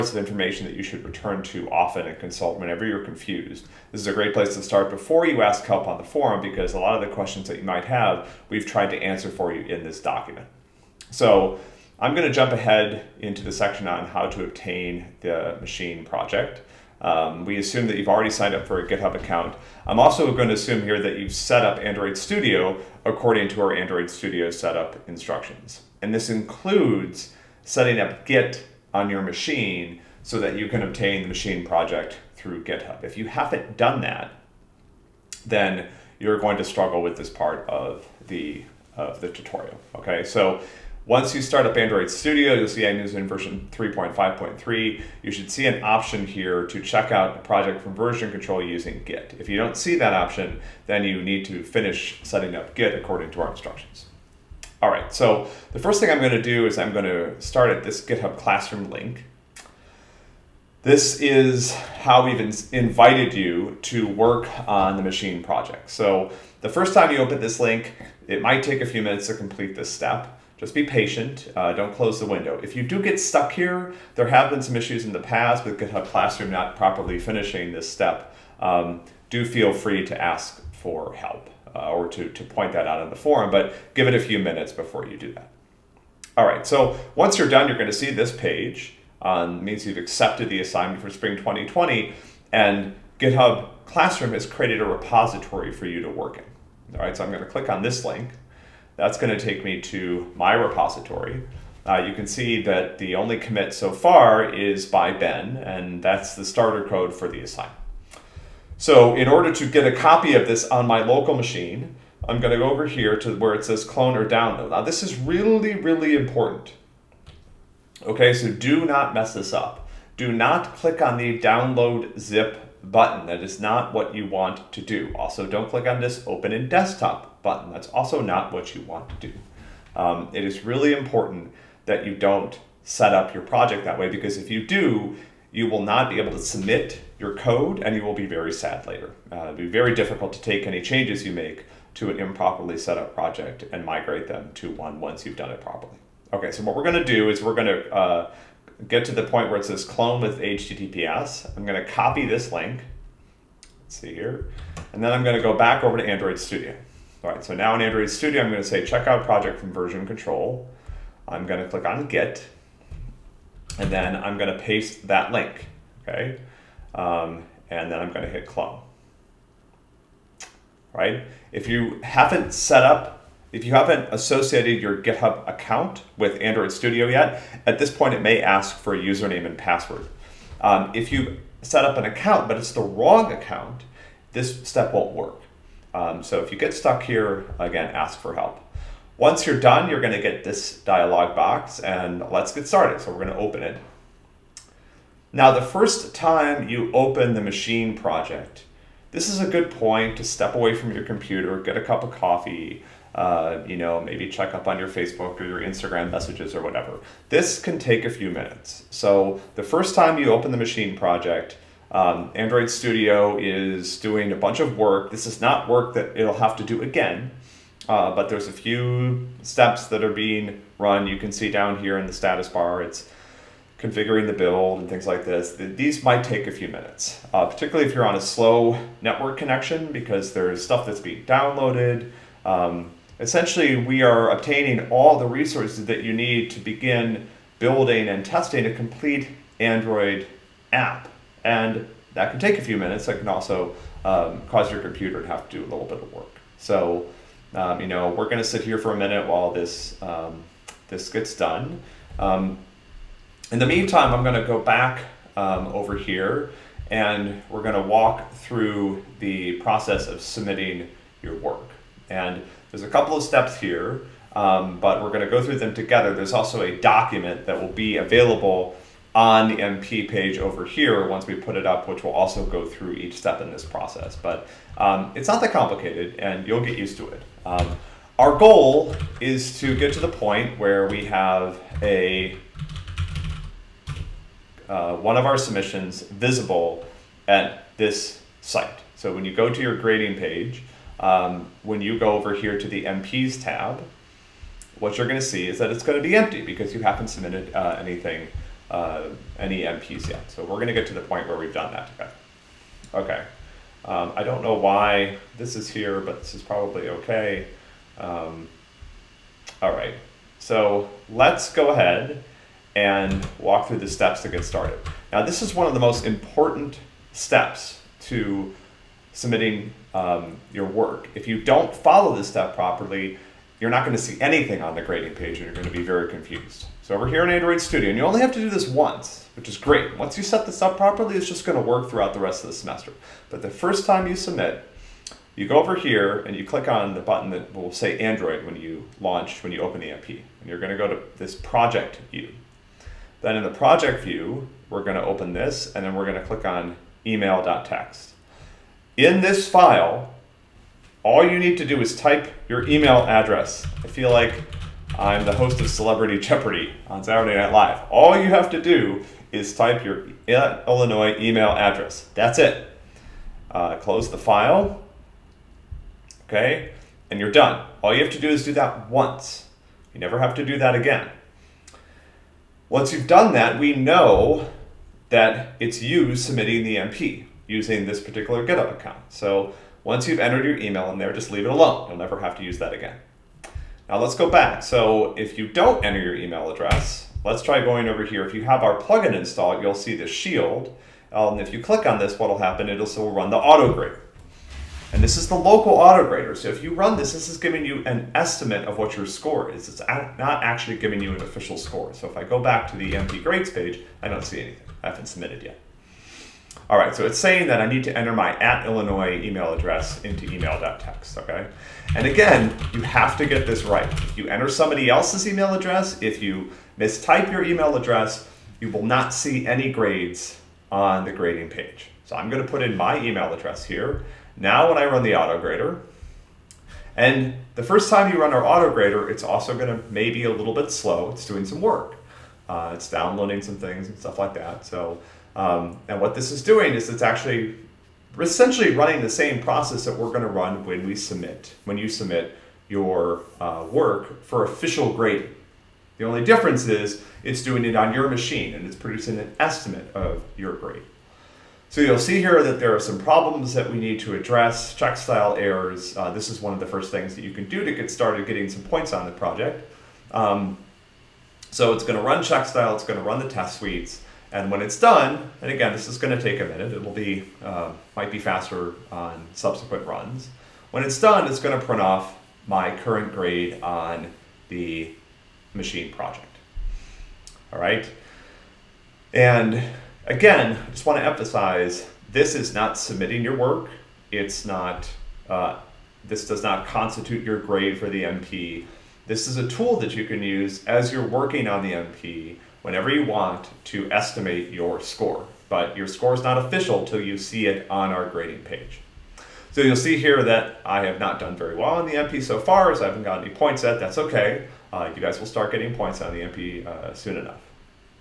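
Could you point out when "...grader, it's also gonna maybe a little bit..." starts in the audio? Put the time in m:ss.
7:08.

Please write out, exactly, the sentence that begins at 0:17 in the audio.
Um, we assume that you've already signed up for a GitHub account.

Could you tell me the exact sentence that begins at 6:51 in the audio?
And again, you have to get this right.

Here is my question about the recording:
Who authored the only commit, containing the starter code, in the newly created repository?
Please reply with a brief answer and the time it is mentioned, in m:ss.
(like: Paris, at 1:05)
Ben, at 1:45.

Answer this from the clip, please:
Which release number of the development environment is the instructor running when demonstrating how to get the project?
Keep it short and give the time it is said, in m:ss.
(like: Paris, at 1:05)
3.5.3, at 0:43.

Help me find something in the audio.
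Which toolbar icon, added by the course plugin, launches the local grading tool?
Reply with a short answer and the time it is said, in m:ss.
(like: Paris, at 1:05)
the shield, at 6:29.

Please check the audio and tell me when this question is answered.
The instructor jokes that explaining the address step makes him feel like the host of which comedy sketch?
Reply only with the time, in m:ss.
5:55.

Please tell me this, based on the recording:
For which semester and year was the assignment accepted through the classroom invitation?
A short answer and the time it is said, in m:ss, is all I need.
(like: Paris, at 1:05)
spring 2020, at 1:31.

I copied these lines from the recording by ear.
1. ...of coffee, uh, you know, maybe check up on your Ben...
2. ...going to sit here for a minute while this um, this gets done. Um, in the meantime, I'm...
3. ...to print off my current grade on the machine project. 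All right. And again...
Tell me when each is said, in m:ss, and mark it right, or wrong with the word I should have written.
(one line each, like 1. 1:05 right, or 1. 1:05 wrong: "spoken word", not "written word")
1. 3:22 wrong: "Facebook", not "Ben"
2. 4:08 right
3. 7:51 right.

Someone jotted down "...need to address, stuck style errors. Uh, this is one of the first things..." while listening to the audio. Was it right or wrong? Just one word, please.
wrong.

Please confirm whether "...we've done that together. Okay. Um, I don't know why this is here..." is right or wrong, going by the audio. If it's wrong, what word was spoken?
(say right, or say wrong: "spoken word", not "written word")
right.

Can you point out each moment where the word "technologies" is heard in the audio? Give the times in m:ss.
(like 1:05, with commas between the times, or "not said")
not said.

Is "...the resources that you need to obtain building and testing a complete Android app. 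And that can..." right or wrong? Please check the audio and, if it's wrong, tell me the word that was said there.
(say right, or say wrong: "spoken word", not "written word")
wrong: "begin", not "obtain".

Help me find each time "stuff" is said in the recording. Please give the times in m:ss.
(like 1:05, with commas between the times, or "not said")
3:50, 7:13.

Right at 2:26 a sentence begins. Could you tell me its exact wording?
Okay, so what we're gonna do is we're gonna uh, get to the point where it says clone with HTTPS.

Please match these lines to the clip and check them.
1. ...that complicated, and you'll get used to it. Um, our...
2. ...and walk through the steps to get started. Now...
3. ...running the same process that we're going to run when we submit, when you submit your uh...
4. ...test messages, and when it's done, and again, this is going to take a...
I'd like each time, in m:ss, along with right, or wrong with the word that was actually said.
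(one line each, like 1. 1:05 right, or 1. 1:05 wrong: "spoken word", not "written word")
1. 4:35 right
2. 5:12 right
3. 7:18 right
4. 7:43 wrong: "suites", not "messages".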